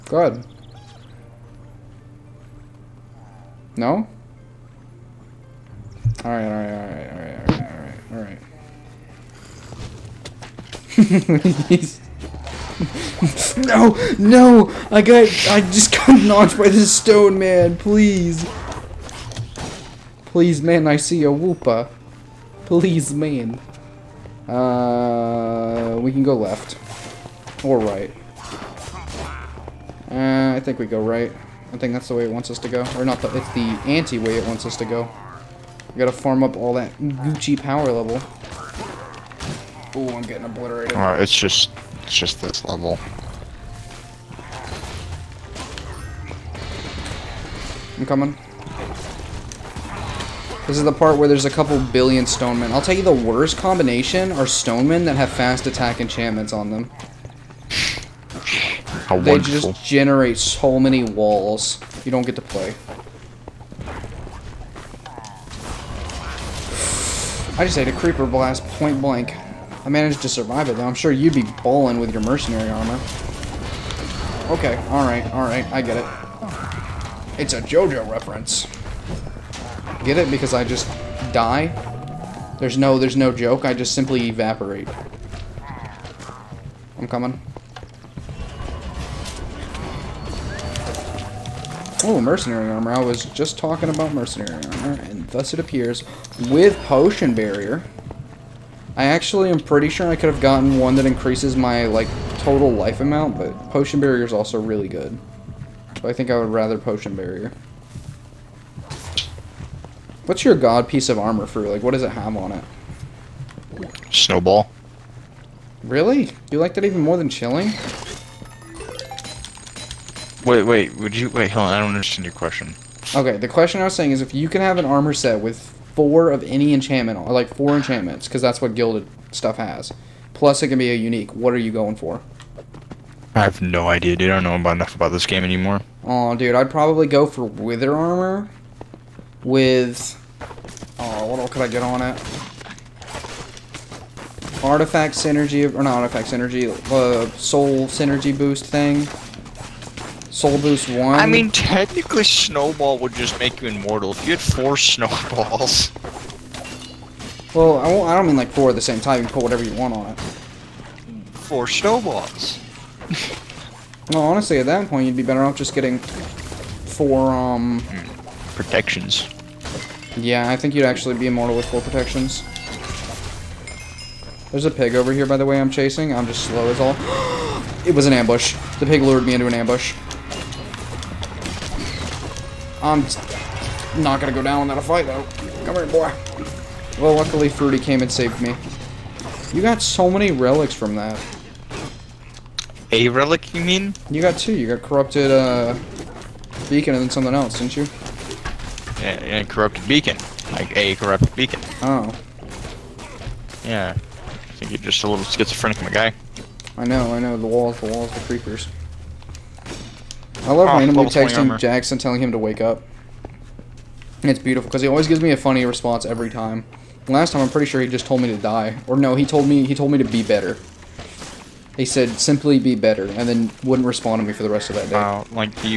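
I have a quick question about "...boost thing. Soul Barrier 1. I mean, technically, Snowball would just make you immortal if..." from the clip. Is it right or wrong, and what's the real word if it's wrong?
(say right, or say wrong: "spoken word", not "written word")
wrong: "Boost", not "Barrier".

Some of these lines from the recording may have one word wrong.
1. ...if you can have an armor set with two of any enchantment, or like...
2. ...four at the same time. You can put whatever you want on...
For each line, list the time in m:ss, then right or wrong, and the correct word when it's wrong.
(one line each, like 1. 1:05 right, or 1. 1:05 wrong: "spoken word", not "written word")
1. 2:04 wrong: "four", not "two"
2. 2:38 right.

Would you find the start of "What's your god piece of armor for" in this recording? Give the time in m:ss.
1:50.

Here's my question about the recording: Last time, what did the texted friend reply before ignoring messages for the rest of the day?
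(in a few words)
Simply be better.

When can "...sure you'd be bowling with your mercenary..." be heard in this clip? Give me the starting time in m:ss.
1:10.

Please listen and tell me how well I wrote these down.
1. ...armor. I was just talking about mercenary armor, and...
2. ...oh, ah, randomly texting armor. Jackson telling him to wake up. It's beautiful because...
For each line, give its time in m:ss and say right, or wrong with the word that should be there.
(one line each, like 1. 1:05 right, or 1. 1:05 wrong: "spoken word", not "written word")
1. 1:32 right
2. 3:30 right.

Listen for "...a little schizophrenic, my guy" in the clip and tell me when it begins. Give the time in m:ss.
3:25.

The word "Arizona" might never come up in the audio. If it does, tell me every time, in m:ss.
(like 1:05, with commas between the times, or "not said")
not said.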